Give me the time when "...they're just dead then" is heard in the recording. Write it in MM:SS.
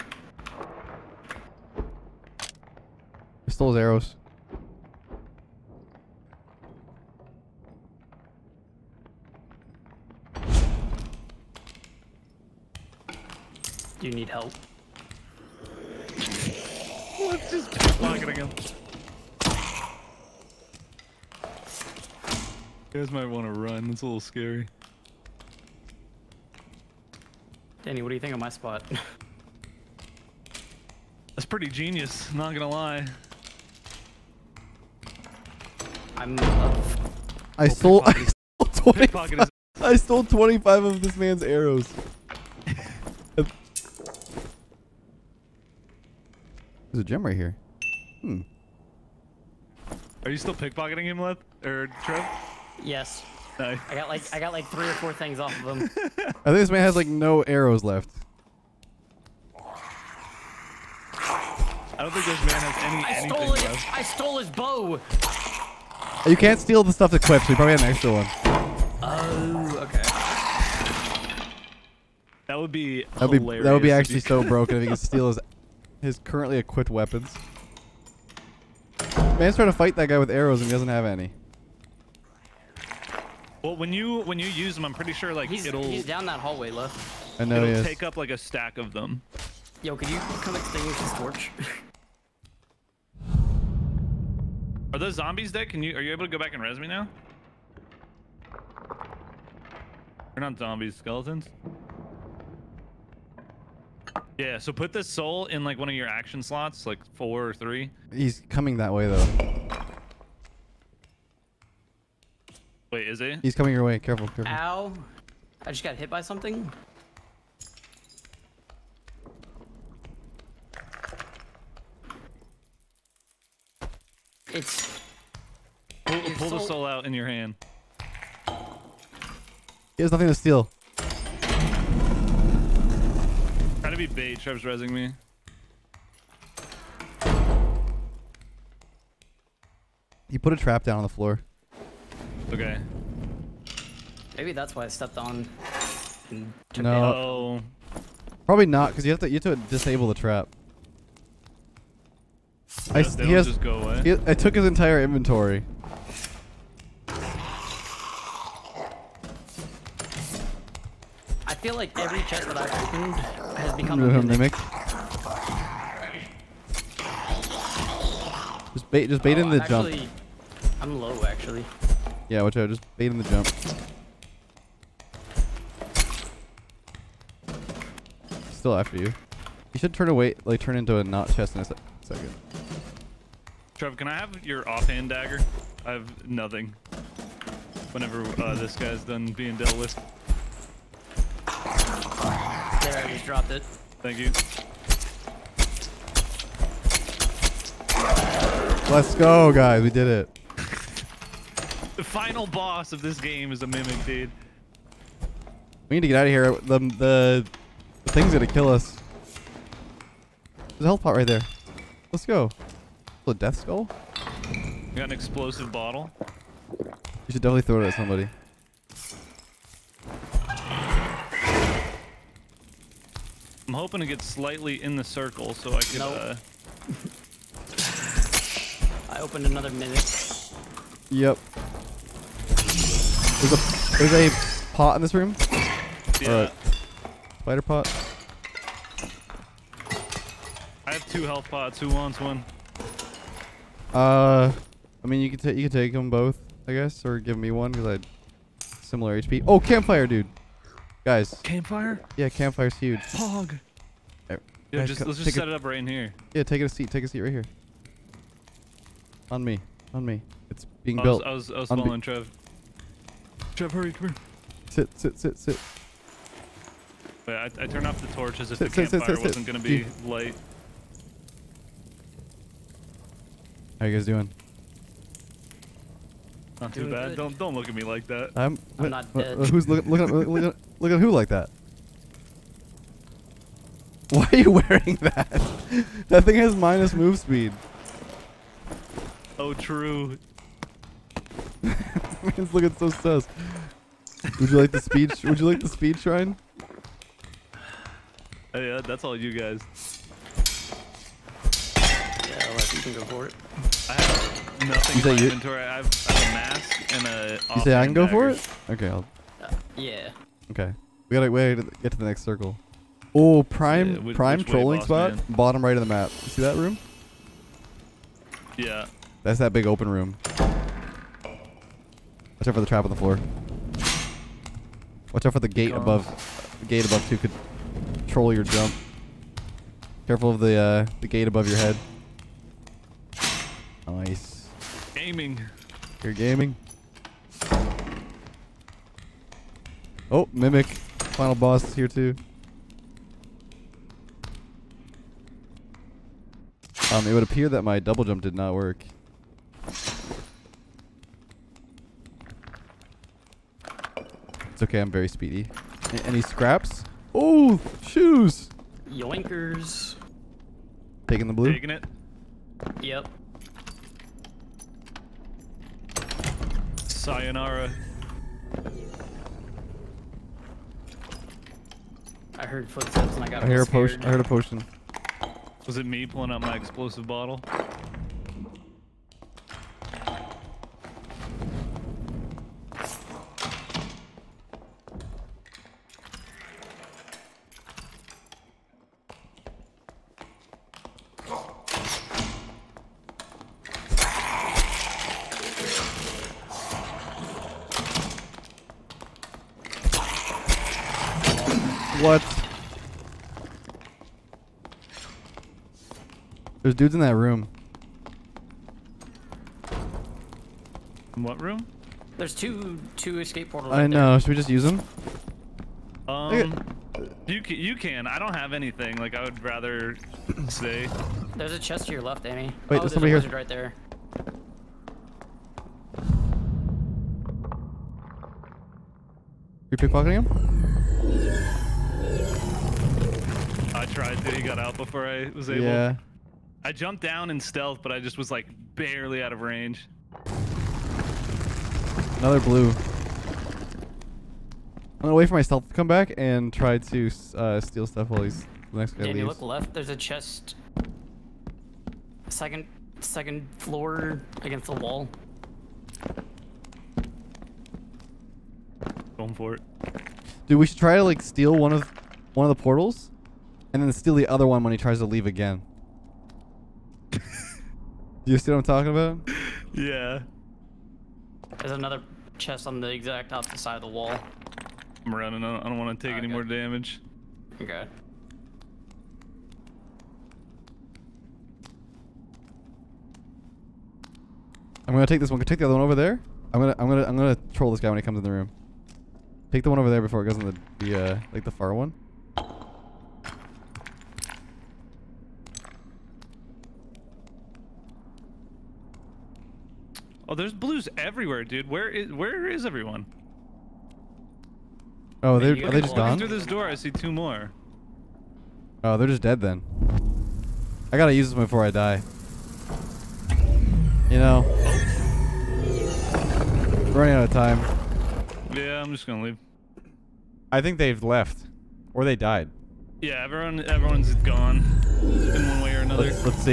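08:28.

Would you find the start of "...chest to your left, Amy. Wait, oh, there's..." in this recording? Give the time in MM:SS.
07:01.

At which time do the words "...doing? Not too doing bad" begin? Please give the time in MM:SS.
04:34.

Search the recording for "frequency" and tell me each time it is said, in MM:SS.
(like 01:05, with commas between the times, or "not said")
not said.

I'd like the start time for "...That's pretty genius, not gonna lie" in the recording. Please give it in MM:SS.
00:31.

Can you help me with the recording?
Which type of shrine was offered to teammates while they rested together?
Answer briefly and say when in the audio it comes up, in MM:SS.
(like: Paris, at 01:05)
Speed shrine, at 04:55.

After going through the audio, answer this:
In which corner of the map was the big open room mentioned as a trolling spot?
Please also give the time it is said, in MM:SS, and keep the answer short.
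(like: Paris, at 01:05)
Bottom right, at 05:15.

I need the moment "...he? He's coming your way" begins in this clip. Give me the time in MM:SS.
01:53.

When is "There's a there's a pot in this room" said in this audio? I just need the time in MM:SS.
03:52.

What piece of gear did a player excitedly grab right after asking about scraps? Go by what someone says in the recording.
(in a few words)
Shoes.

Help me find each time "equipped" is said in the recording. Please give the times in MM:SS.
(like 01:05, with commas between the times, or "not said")
01:07, 01:16.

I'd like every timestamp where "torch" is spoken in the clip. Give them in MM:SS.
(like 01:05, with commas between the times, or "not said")
01:31, 04:28.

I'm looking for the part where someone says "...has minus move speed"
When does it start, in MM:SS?
04:46.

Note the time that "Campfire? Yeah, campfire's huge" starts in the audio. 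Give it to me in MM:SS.
04:11.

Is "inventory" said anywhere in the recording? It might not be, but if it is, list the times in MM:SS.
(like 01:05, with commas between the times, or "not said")
02:35, 05:05.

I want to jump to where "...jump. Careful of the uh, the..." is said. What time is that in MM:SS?
05:28.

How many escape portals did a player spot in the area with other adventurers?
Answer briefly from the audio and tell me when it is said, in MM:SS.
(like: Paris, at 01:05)
2, at 06:52.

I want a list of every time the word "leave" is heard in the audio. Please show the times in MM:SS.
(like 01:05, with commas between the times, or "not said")
07:29, 07:45, 08:39.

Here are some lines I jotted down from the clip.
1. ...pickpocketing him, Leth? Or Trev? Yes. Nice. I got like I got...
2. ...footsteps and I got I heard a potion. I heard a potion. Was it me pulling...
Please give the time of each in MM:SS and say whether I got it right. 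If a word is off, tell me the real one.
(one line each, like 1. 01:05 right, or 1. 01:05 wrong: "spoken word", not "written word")
1. 00:50 right
2. 06:12 right.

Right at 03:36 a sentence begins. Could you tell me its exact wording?
You should definitely throw it at somebody.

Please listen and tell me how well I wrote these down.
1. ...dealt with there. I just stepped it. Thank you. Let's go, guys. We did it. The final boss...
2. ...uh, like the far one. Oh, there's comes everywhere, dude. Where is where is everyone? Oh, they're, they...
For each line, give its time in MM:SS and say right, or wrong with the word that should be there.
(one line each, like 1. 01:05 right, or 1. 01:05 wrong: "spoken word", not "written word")
1. 03:09 wrong: "dropped", not "stepped"
2. 08:11 wrong: "blues", not "comes".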